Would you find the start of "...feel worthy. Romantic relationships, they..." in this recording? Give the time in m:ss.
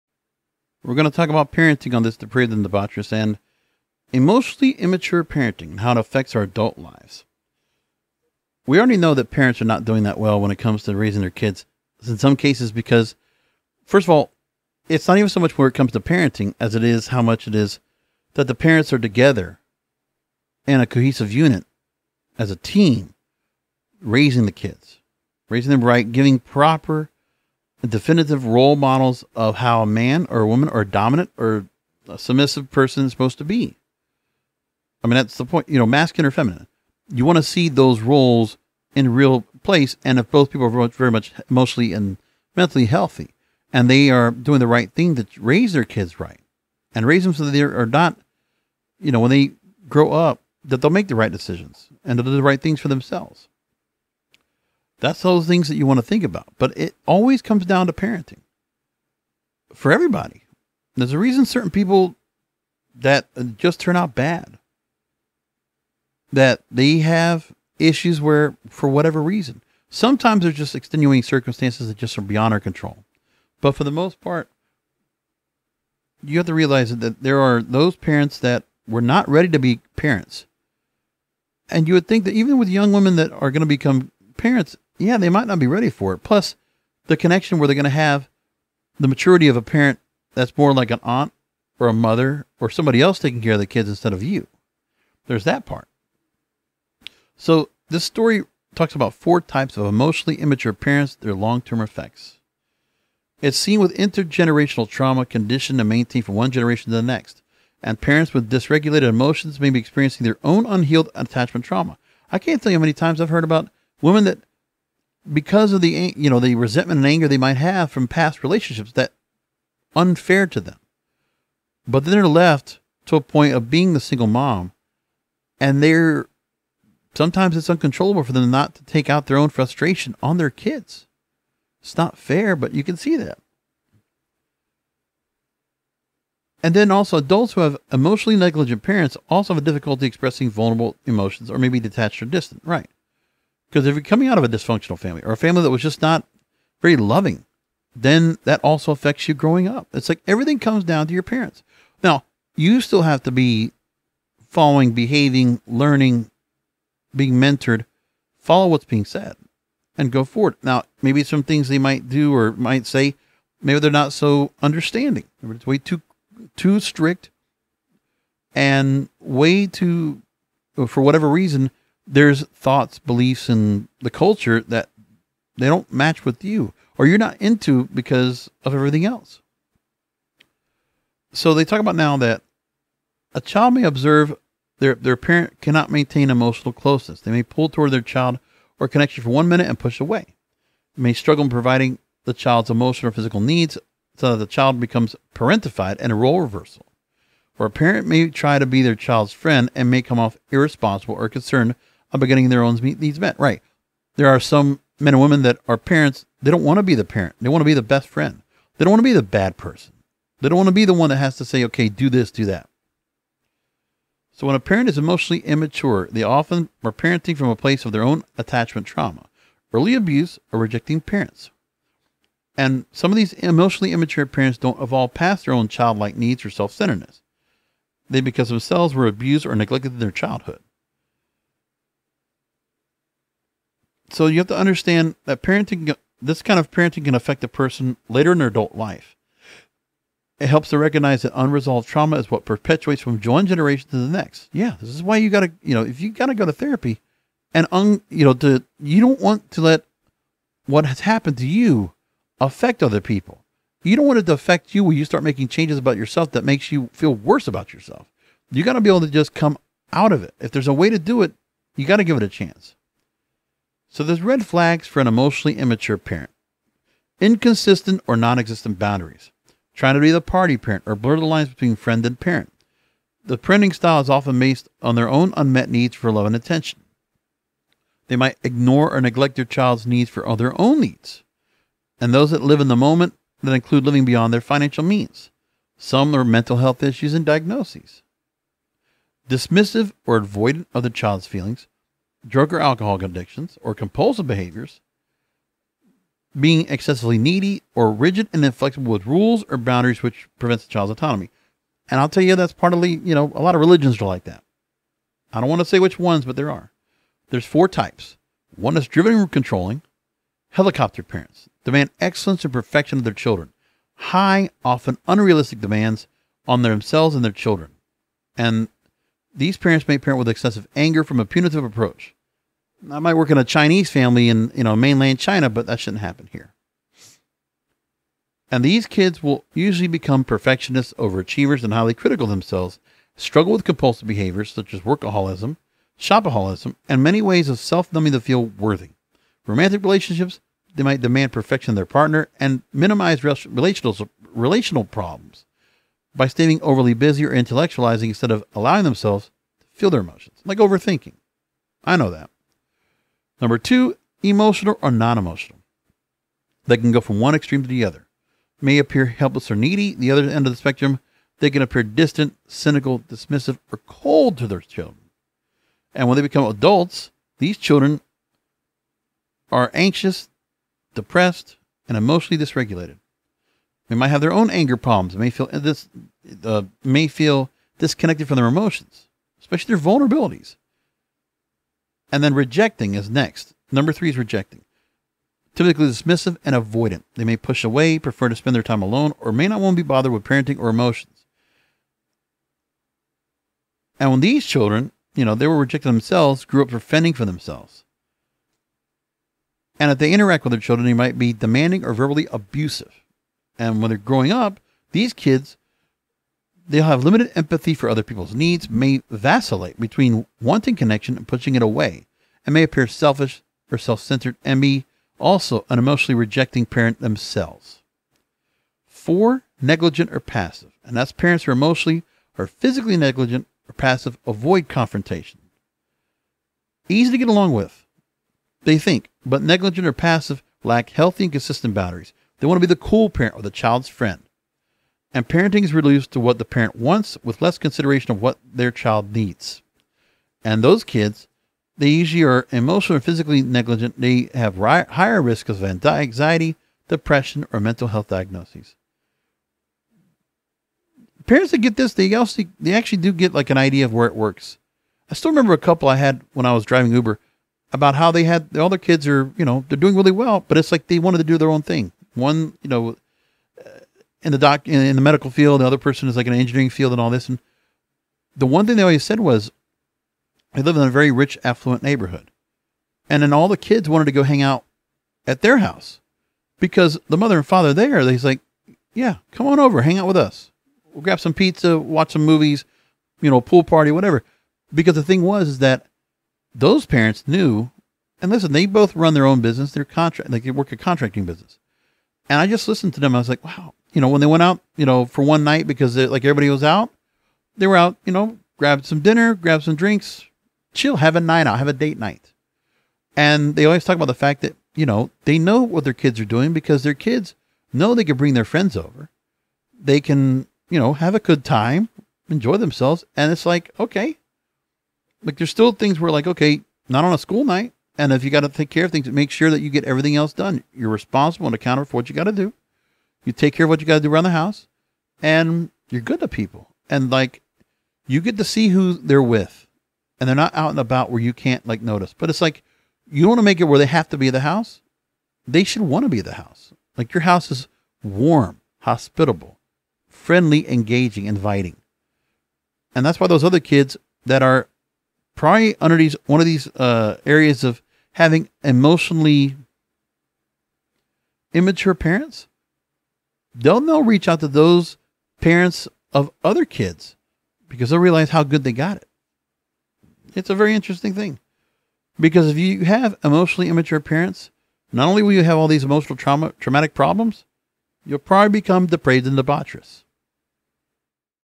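5:38.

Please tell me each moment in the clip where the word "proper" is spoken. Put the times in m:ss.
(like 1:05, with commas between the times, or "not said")
0:26.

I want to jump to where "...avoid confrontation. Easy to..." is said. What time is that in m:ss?
7:04.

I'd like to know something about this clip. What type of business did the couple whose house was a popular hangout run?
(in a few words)
Contracting business.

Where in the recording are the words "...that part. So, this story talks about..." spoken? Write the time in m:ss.
1:35.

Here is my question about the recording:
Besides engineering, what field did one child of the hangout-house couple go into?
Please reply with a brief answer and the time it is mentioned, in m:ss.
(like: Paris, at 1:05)
Medical field, at 7:45.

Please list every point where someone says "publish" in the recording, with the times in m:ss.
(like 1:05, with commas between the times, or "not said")
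not said.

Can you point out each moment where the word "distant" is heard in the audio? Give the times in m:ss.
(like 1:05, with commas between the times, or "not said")
2:22, 6:01.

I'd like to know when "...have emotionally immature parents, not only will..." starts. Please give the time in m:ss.
9:22.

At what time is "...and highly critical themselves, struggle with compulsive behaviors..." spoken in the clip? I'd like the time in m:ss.
5:31.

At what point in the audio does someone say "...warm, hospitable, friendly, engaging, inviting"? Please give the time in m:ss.
8:58.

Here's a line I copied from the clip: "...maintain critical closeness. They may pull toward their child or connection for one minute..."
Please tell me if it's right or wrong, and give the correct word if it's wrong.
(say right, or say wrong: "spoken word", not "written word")
wrong: "emotional", not "critical".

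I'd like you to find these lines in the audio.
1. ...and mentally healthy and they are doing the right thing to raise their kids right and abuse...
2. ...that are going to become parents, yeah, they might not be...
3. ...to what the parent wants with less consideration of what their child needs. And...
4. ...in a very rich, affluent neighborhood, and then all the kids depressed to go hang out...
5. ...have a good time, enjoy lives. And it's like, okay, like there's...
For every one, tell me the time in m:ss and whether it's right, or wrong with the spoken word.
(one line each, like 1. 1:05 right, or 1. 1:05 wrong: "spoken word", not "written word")
1. 0:41 wrong: "raise", not "abuse"
2. 1:23 right
3. 7:16 right
4. 7:50 wrong: "wanted", not "depressed"
5. 8:30 wrong: "themselves", not "lives".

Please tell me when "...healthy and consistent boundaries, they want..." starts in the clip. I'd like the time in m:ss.
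7:10.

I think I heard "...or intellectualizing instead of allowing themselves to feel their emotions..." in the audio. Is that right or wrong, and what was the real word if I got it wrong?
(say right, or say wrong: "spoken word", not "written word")
right.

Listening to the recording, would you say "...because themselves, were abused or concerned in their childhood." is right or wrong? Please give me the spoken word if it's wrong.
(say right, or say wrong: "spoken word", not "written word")
wrong: "neglected", not "concerned".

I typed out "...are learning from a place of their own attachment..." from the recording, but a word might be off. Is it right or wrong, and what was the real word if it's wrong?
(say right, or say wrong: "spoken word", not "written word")
wrong: "parenting", not "learning".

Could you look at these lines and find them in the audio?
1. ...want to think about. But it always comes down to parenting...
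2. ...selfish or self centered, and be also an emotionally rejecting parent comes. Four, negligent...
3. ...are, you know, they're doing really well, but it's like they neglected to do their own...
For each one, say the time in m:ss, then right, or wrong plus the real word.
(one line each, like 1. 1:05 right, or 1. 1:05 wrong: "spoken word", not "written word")
1. 0:55 right
2. 6:52 wrong: "themselves", not "comes"
3. 7:39 wrong: "wanted", not "neglected".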